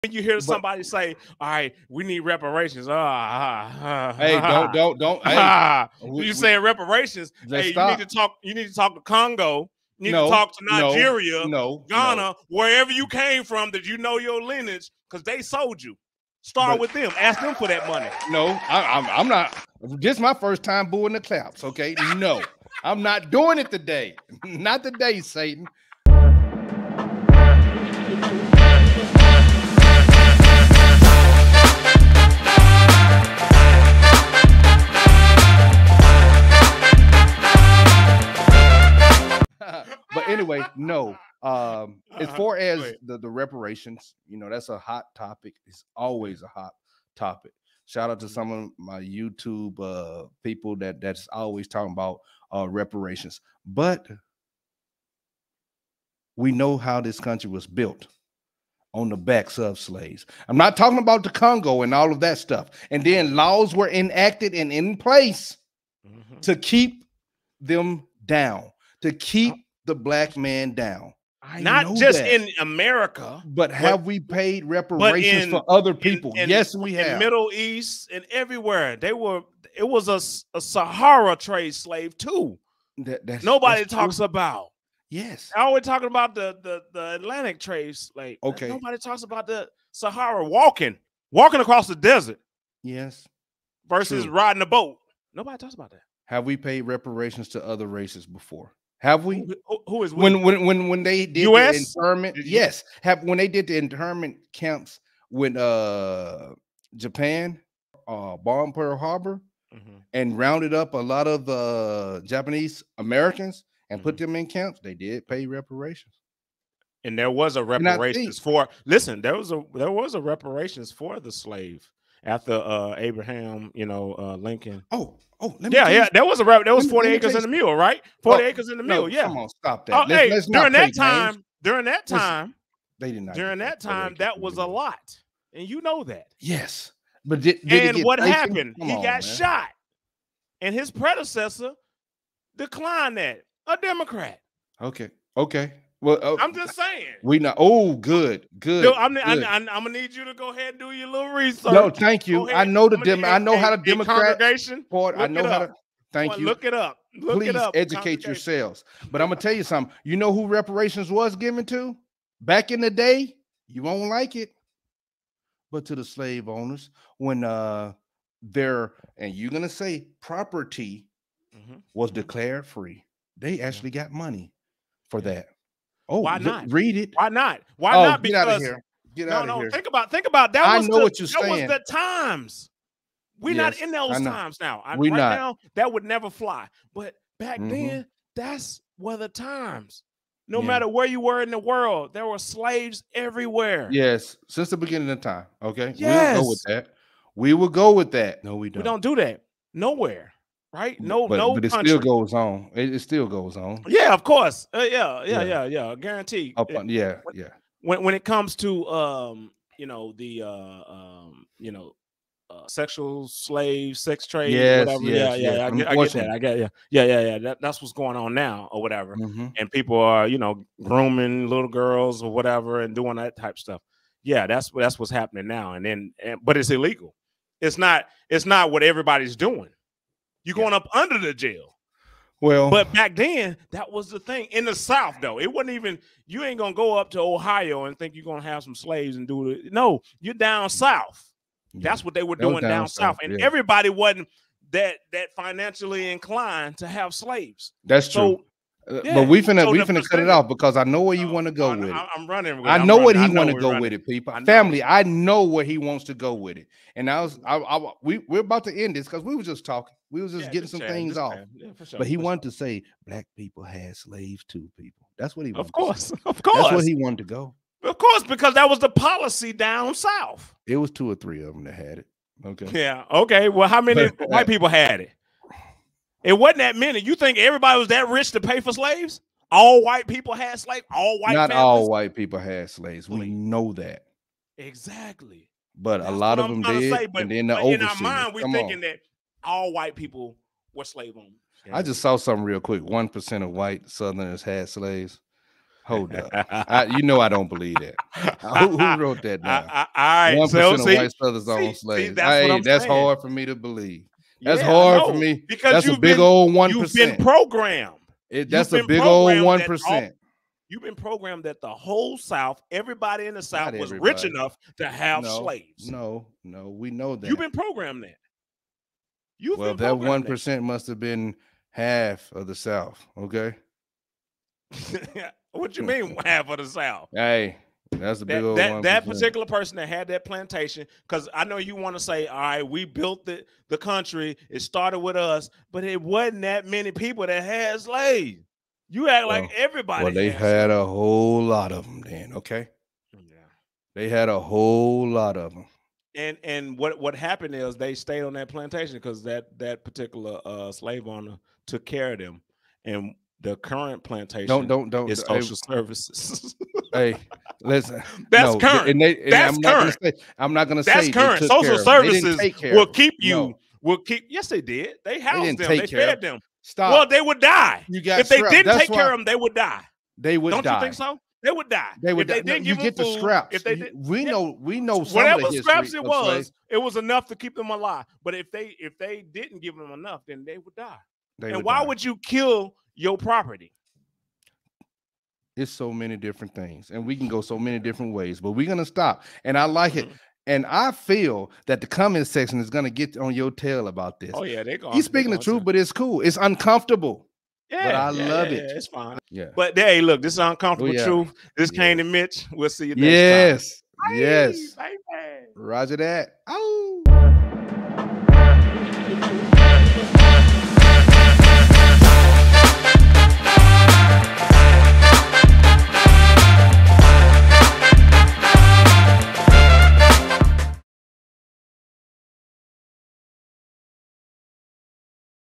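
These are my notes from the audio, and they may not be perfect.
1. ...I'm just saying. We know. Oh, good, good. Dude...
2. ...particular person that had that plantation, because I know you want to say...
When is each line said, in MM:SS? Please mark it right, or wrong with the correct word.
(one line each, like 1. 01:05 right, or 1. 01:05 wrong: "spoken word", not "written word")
1. 02:26 right
2. 05:29 right.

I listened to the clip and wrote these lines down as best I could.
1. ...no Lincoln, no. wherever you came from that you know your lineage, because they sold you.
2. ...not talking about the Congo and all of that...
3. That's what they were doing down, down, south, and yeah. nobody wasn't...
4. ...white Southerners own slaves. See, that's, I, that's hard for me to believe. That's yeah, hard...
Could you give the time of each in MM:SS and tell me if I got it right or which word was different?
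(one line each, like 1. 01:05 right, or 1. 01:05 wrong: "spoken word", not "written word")
1. 00:11 wrong: "Ghana", not "Lincoln"
2. 01:00 right
3. 04:01 wrong: "everybody", not "nobody"
4. 05:00 right.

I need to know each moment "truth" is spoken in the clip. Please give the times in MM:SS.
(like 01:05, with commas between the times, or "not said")
06:35, 06:41.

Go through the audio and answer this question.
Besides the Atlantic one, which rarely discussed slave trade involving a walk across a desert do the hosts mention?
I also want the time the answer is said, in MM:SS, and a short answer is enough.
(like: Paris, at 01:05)
Sahara trade, at 01:20.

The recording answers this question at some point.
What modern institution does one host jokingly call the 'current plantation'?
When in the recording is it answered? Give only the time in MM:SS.
06:01.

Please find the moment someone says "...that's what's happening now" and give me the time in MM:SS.
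03:44.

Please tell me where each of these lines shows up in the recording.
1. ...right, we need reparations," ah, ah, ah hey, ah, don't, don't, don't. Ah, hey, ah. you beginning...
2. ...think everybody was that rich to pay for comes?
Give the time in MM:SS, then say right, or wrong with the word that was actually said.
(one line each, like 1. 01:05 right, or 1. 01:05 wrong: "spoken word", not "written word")
1. 00:01 wrong: "saying", not "beginning"
2. 04:37 wrong: "slaves", not "comes".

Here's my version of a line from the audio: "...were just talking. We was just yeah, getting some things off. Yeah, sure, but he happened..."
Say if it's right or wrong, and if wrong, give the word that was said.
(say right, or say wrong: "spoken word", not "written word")
wrong: "wanted", not "happened".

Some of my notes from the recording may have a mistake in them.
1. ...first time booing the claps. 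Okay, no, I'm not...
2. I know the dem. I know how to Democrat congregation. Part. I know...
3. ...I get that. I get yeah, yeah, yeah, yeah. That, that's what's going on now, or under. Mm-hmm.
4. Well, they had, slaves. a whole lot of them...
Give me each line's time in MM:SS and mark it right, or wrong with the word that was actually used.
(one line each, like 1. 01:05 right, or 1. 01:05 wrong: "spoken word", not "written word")
1. 00:20 right
2. 02:32 right
3. 03:35 wrong: "whatever", not "under"
4. 05:40 right.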